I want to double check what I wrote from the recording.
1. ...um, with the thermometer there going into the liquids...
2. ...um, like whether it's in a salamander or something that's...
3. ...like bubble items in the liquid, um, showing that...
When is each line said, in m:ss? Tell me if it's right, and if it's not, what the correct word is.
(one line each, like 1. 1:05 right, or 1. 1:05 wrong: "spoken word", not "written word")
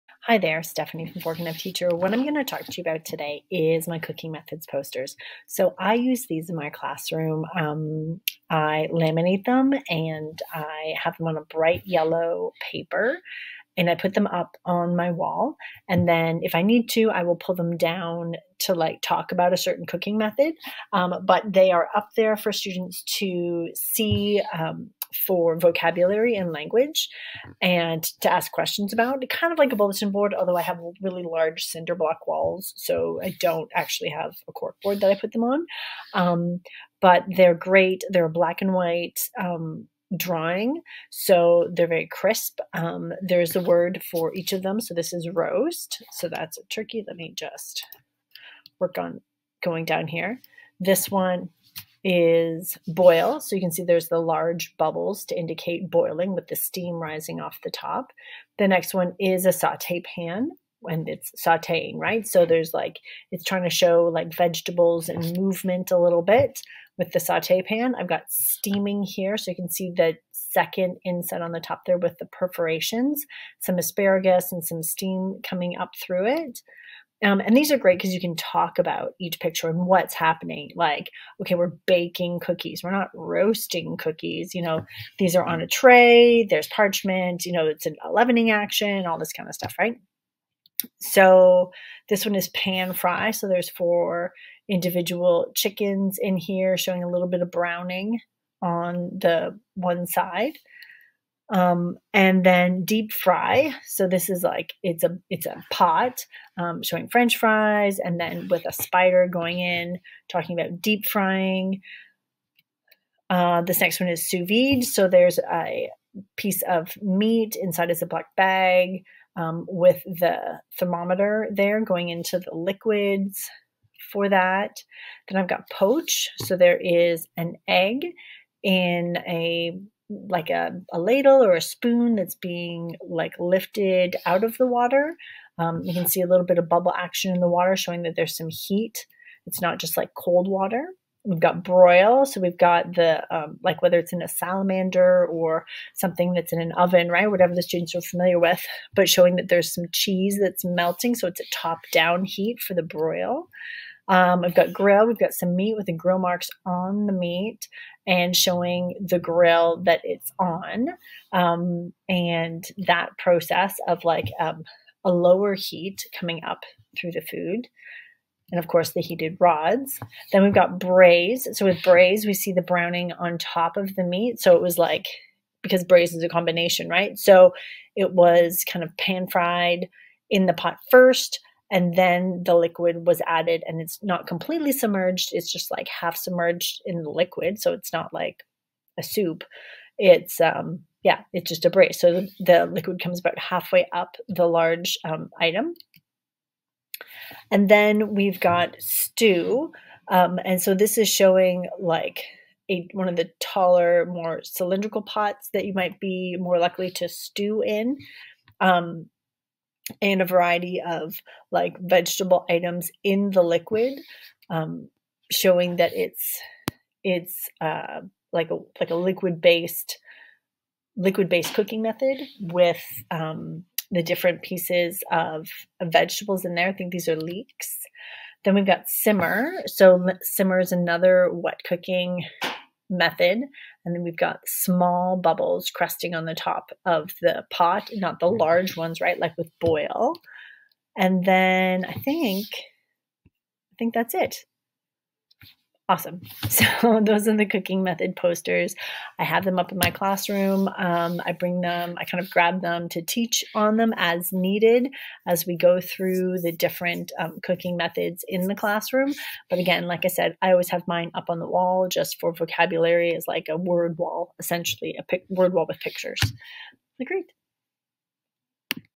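1. 1:59 right
2. 2:23 right
3. 3:31 wrong: "vegetable", not "bubble".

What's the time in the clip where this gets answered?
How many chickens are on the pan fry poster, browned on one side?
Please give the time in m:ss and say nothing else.
1:33.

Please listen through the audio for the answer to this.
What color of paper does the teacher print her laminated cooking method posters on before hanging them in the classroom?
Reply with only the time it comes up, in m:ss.
0:11.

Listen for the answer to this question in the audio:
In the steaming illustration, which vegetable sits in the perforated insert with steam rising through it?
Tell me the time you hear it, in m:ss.
1:13.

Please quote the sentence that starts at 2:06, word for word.
So there is an egg in a like a, a ladle or a spoon that's being like lifted out of the water.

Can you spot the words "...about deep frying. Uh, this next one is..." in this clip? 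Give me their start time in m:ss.
1:50.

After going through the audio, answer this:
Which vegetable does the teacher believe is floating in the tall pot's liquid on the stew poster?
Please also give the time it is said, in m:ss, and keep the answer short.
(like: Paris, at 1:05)
leeks, at 3:47.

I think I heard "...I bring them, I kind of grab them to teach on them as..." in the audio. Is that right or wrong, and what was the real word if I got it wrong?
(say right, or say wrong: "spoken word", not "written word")
right.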